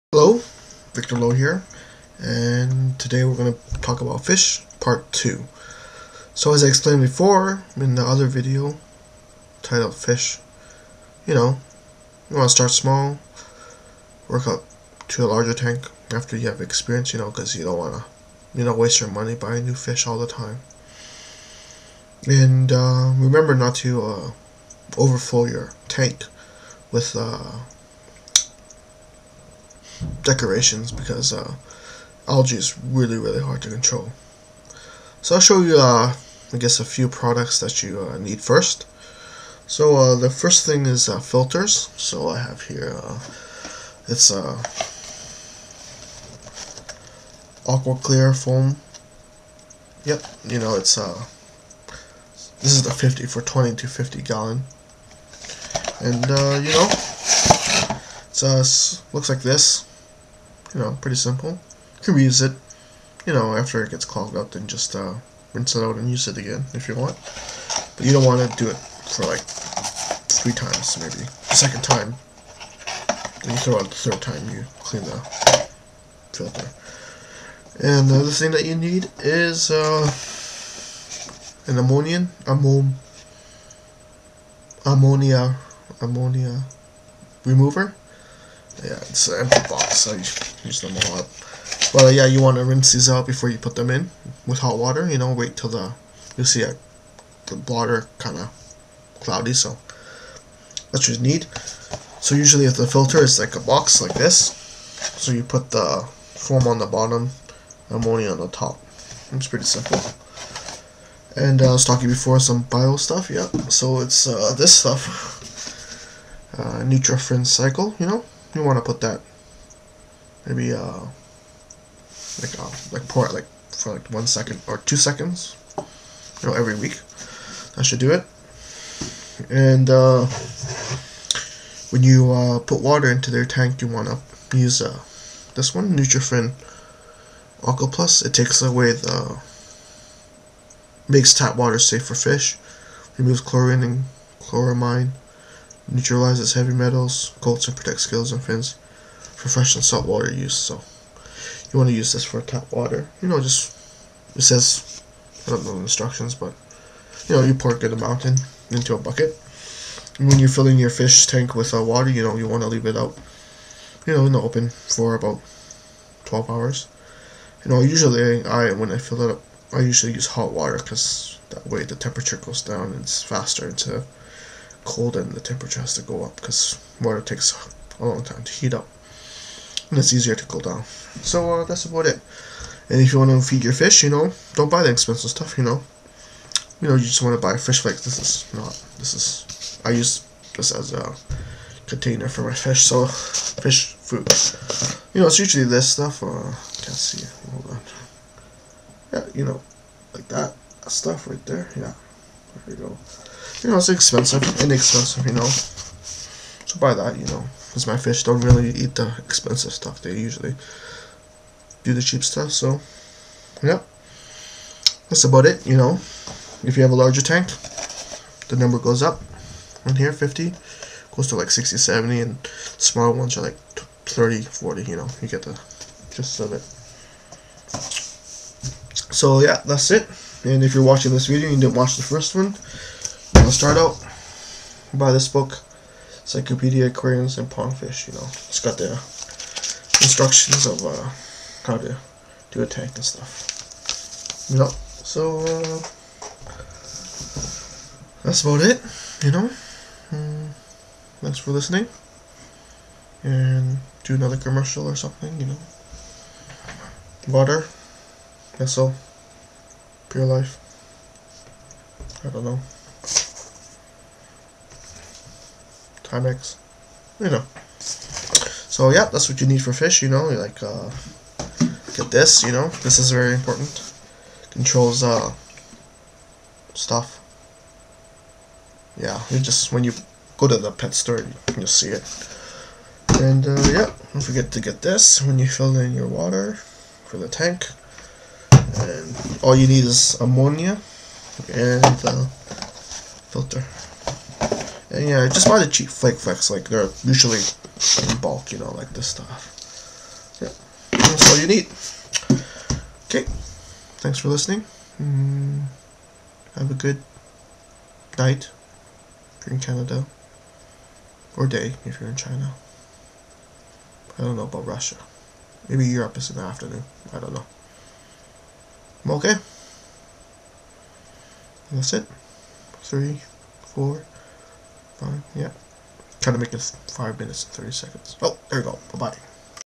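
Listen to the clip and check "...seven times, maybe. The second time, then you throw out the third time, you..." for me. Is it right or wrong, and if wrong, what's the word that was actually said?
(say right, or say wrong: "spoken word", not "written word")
wrong: "three", not "seven".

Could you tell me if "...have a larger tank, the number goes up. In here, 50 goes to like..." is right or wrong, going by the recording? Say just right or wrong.
right.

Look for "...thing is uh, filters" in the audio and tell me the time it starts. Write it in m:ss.
0:40.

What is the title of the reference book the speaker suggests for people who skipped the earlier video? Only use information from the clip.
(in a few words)
Encyclopedia Aquariums and Pondfish.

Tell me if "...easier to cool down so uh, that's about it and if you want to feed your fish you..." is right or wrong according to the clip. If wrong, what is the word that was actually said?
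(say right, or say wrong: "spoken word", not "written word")
right.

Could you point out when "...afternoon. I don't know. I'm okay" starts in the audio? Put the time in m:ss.
5:16.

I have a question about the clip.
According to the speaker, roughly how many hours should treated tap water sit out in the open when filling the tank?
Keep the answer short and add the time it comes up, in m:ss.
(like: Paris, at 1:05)
12 hours, at 2:46.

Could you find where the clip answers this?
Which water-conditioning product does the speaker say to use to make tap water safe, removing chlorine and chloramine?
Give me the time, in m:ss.
2:15.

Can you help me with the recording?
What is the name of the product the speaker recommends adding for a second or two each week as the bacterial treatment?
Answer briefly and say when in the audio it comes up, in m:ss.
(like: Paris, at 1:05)
Nutrafin Cycle, at 1:56.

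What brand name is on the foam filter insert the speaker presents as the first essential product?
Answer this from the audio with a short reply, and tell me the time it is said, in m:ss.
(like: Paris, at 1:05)
AquaClear, at 0:47.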